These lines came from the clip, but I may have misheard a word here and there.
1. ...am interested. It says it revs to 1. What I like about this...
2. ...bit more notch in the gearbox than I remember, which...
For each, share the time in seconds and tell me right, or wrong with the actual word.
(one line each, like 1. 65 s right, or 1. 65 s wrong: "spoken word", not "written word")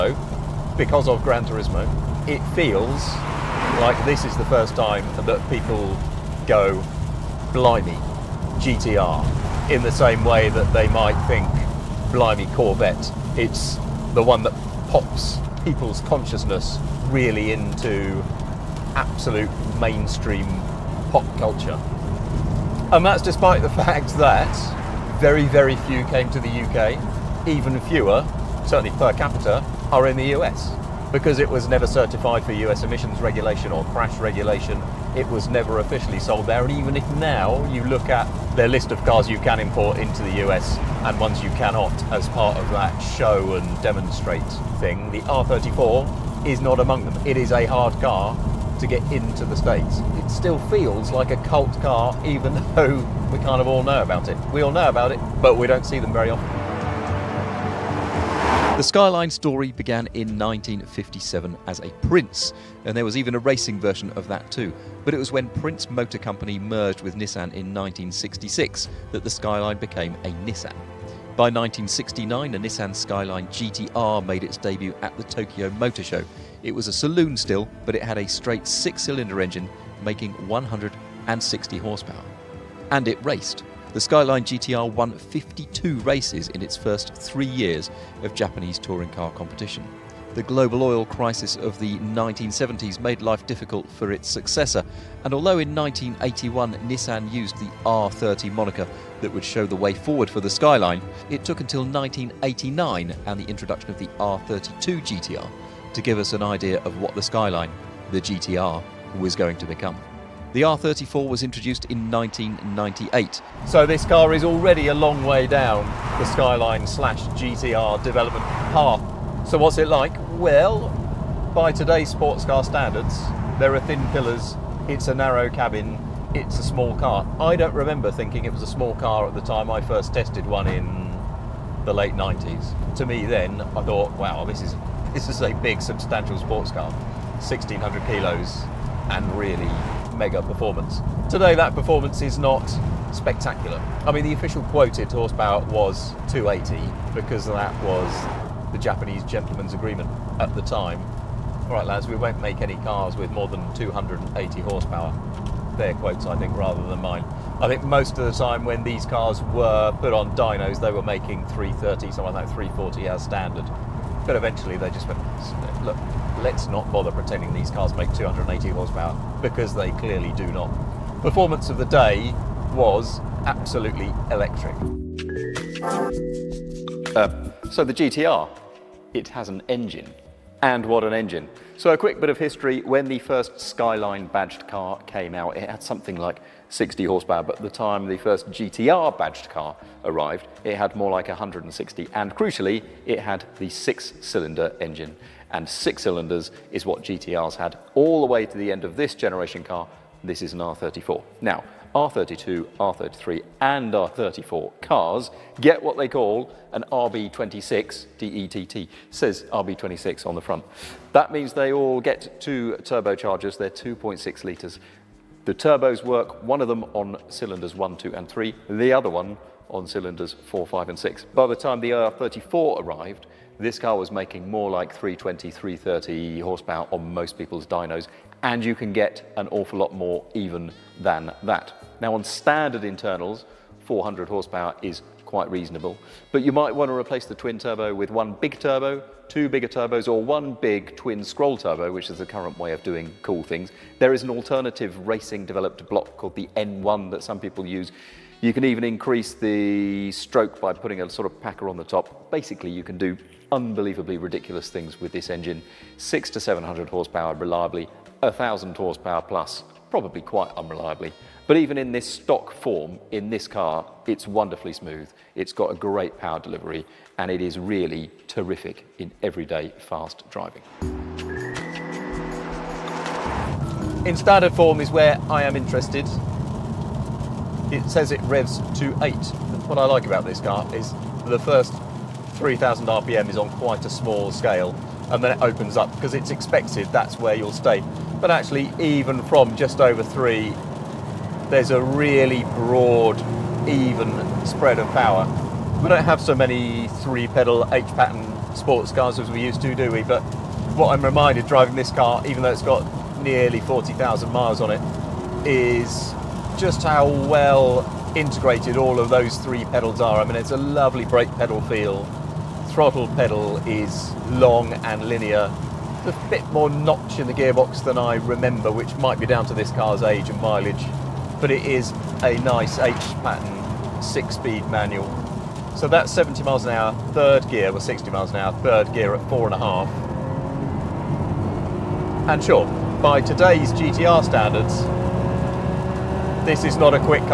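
1. 275 s wrong: "8", not "1"
2. 316 s right.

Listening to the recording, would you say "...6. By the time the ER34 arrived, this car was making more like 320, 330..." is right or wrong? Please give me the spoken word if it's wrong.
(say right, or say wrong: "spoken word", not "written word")
right.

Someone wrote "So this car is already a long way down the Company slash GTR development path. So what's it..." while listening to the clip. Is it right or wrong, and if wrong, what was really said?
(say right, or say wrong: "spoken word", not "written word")
wrong: "Skyline", not "Company".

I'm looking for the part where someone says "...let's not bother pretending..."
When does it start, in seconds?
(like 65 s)
166 s.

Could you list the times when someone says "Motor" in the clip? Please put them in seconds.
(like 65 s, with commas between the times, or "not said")
65 s, 75 s.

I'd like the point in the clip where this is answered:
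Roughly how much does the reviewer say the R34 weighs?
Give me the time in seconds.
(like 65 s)
136 s.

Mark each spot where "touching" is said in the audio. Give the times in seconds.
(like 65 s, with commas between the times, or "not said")
not said.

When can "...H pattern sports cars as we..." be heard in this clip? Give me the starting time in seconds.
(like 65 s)
297 s.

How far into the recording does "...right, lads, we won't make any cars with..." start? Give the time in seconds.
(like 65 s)
151 s.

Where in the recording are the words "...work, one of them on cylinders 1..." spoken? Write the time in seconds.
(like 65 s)
216 s.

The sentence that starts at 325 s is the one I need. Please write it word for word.
So that's 70 miles an hour, third gear, well 60 miles an hour, third gear at four and a half.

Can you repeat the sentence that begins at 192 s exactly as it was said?
And crucially, it had the six cylinder engine.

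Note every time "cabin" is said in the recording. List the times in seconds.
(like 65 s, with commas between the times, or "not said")
125 s.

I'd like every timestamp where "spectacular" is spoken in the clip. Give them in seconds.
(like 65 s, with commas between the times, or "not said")
143 s.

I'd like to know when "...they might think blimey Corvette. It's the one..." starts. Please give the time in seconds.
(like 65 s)
10 s.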